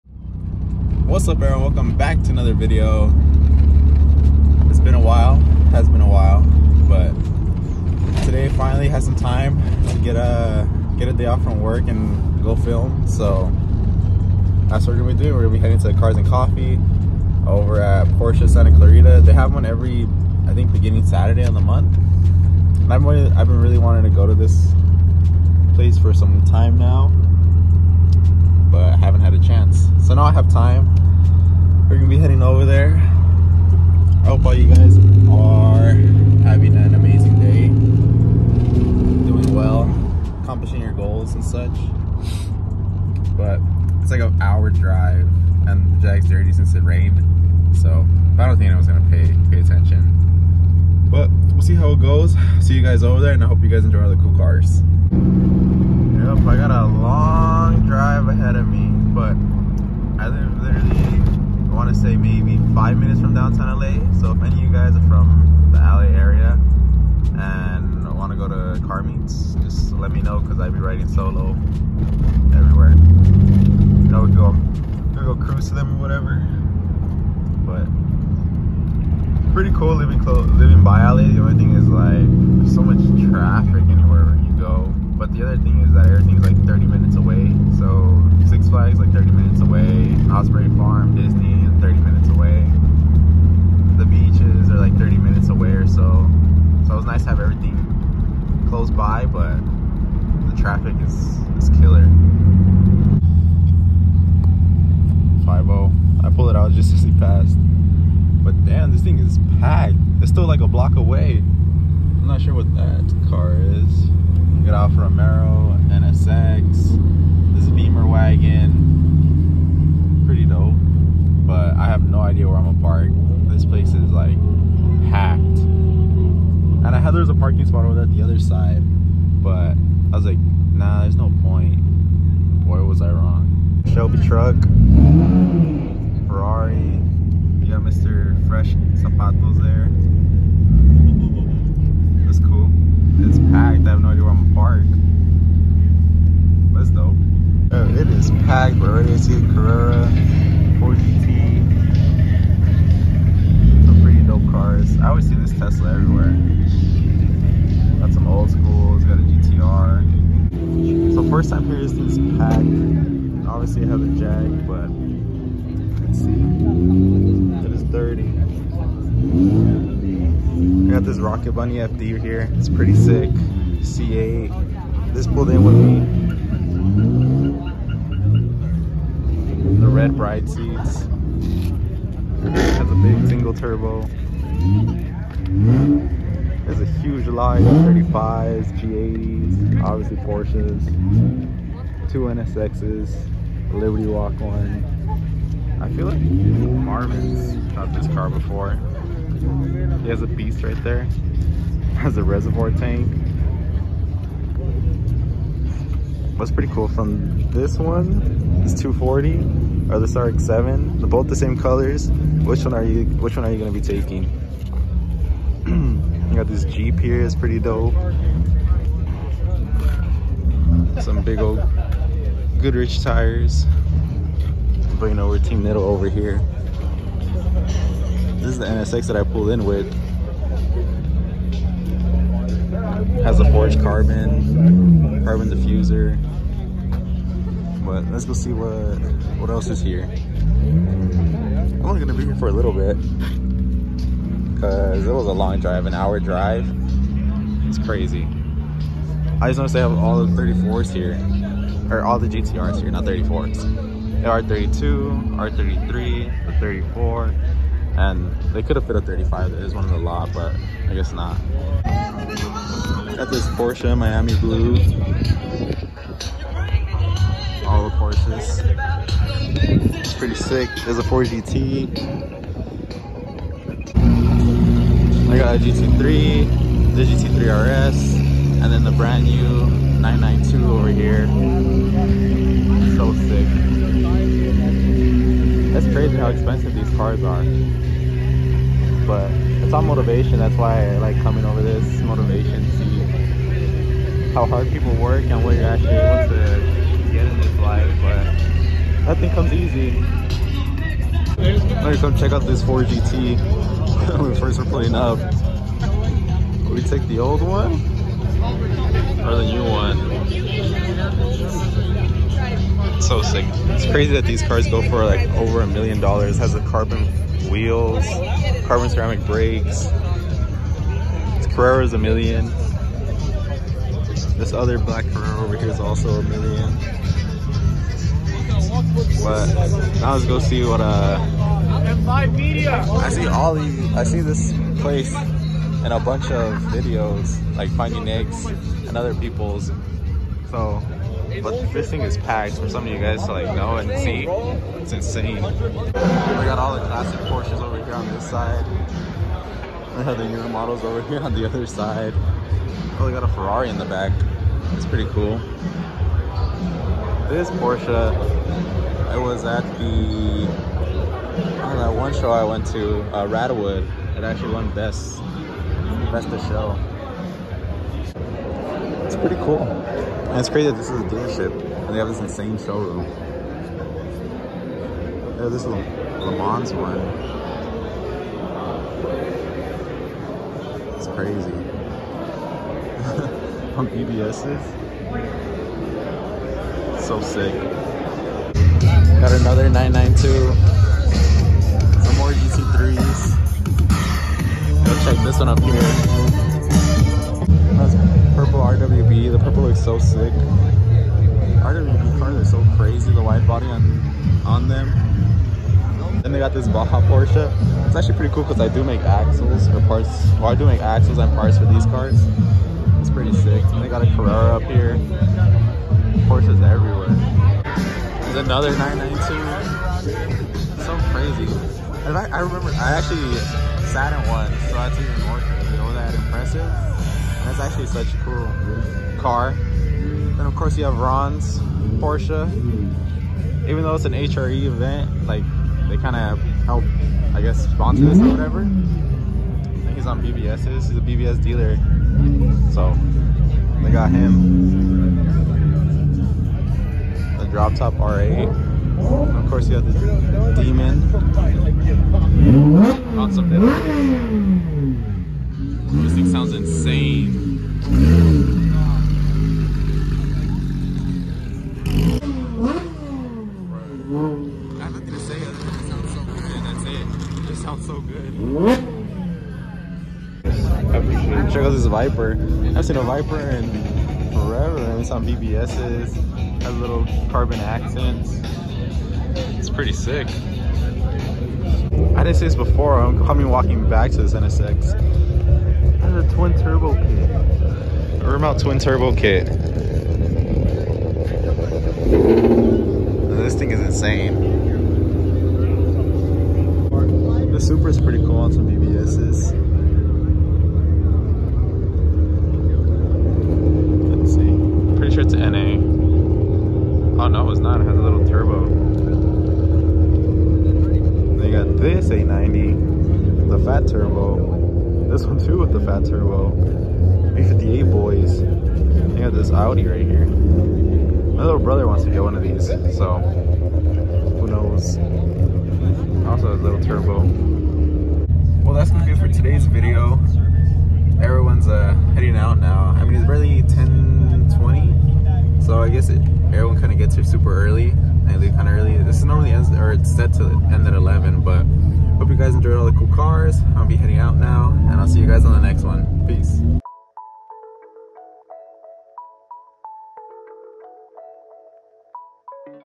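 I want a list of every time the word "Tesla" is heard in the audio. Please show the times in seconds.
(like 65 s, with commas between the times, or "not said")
155 s.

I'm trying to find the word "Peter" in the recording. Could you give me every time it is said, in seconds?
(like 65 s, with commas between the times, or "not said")
not said.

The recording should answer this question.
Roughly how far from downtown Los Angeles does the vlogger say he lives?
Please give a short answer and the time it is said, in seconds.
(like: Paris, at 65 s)
5 minutes, at 62 s.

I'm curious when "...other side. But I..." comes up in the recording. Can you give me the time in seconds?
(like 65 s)
128 s.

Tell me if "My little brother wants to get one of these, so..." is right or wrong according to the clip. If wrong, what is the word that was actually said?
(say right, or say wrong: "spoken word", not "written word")
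right.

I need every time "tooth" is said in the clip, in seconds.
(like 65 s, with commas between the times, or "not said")
not said.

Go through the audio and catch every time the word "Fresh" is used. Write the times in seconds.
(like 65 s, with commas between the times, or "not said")
138 s.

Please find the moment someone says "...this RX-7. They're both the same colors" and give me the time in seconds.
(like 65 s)
209 s.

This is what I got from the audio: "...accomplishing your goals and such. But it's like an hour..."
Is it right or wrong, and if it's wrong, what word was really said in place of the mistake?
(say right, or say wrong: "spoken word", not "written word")
right.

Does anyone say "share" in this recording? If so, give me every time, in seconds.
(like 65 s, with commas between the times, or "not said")
not said.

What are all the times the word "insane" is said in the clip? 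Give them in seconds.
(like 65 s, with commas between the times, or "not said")
344 s, 372 s, 493 s.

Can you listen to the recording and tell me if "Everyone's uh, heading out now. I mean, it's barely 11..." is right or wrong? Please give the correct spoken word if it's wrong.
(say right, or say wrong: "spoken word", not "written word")
wrong: "10", not "11".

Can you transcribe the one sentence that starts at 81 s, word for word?
The only thing is like there's so much traffic anywhere you go.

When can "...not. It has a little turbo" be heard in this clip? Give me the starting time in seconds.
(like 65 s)
507 s.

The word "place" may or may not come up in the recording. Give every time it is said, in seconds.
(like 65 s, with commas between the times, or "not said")
25 s, 123 s, 334 s.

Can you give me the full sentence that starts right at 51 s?
But we'll see how it goes.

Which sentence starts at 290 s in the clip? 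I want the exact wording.
That's why I like coming over this motivation.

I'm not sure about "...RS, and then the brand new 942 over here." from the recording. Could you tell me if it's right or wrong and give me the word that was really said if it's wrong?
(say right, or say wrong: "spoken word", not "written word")
wrong: "992", not "942".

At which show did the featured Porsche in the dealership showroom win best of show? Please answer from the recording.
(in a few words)
Rattawood.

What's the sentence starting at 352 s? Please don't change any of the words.
Oh, we got a Ferrari in the back.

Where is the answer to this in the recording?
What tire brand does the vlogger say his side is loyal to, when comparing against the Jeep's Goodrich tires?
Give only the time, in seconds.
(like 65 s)
225 s.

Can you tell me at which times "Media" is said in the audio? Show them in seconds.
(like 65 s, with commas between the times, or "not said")
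332 s.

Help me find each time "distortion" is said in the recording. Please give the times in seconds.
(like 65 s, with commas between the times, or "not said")
not said.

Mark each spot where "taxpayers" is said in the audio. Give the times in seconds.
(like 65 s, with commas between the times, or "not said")
not said.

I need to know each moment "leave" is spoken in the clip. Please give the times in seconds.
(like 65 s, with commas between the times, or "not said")
538 s.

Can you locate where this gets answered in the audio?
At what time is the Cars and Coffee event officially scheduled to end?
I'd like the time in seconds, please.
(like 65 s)
540 s.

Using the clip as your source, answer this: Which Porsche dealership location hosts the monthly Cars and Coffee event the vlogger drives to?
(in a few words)
Santa Clarita.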